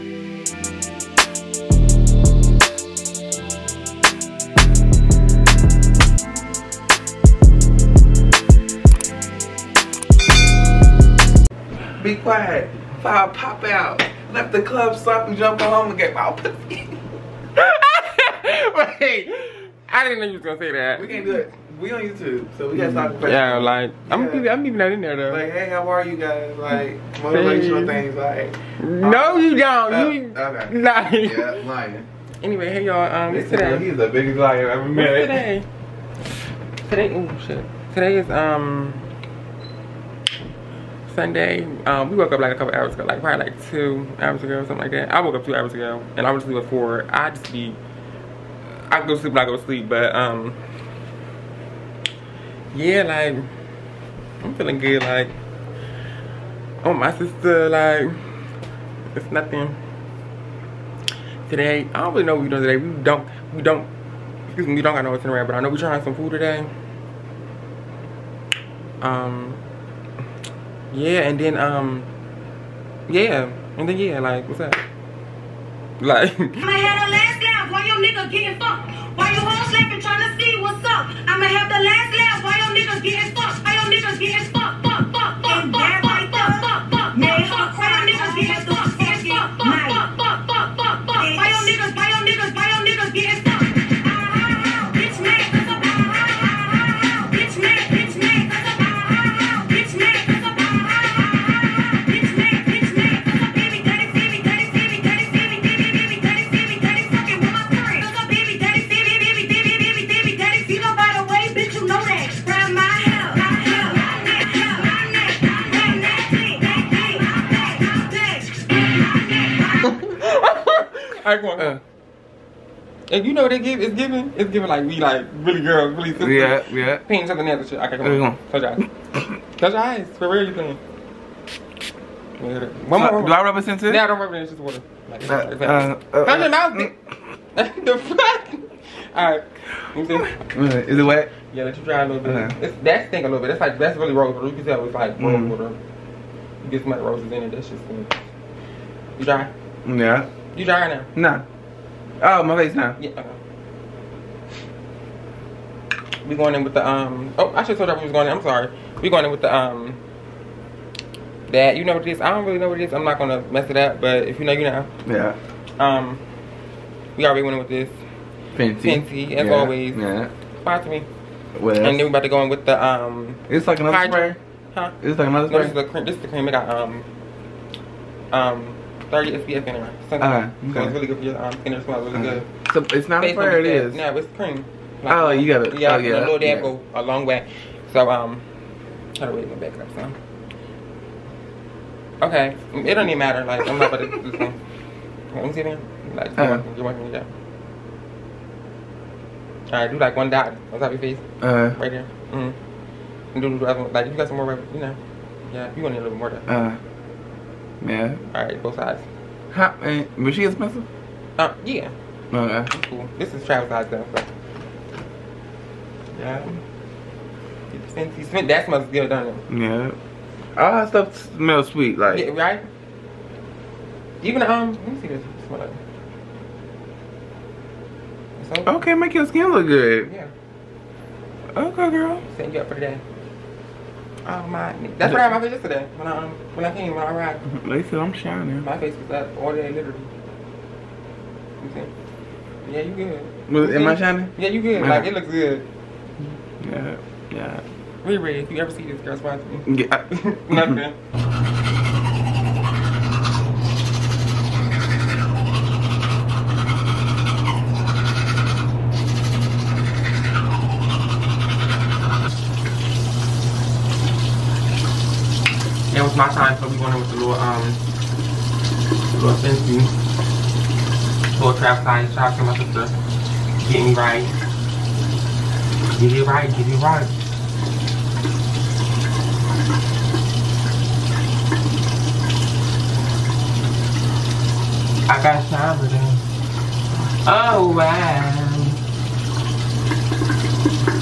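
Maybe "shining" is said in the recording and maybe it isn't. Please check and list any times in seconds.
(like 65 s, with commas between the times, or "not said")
238 s, 243 s.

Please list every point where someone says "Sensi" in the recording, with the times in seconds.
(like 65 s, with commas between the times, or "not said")
269 s.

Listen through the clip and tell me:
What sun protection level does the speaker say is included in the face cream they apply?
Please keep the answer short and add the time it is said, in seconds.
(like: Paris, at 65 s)
30 SPF, at 179 s.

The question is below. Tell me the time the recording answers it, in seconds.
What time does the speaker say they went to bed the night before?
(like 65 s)
46 s.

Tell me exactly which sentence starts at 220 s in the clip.
All her stuff smells sweet, like.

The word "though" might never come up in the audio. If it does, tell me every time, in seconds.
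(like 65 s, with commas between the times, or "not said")
25 s, 213 s.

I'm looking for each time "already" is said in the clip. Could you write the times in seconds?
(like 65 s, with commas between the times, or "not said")
167 s.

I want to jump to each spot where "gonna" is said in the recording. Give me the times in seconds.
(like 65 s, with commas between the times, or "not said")
20 s, 163 s.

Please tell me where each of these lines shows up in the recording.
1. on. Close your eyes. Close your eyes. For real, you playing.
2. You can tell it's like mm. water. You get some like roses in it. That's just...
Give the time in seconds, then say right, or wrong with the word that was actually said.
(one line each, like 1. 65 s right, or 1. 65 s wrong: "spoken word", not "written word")
1. 128 s right
2. 144 s right.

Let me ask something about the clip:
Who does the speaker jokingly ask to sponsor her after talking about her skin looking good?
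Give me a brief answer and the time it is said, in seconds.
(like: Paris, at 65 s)
Riri, at 248 s.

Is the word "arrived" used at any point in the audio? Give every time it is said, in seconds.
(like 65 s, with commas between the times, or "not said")
237 s.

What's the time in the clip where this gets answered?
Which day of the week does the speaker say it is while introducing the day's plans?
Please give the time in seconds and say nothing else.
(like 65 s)
41 s.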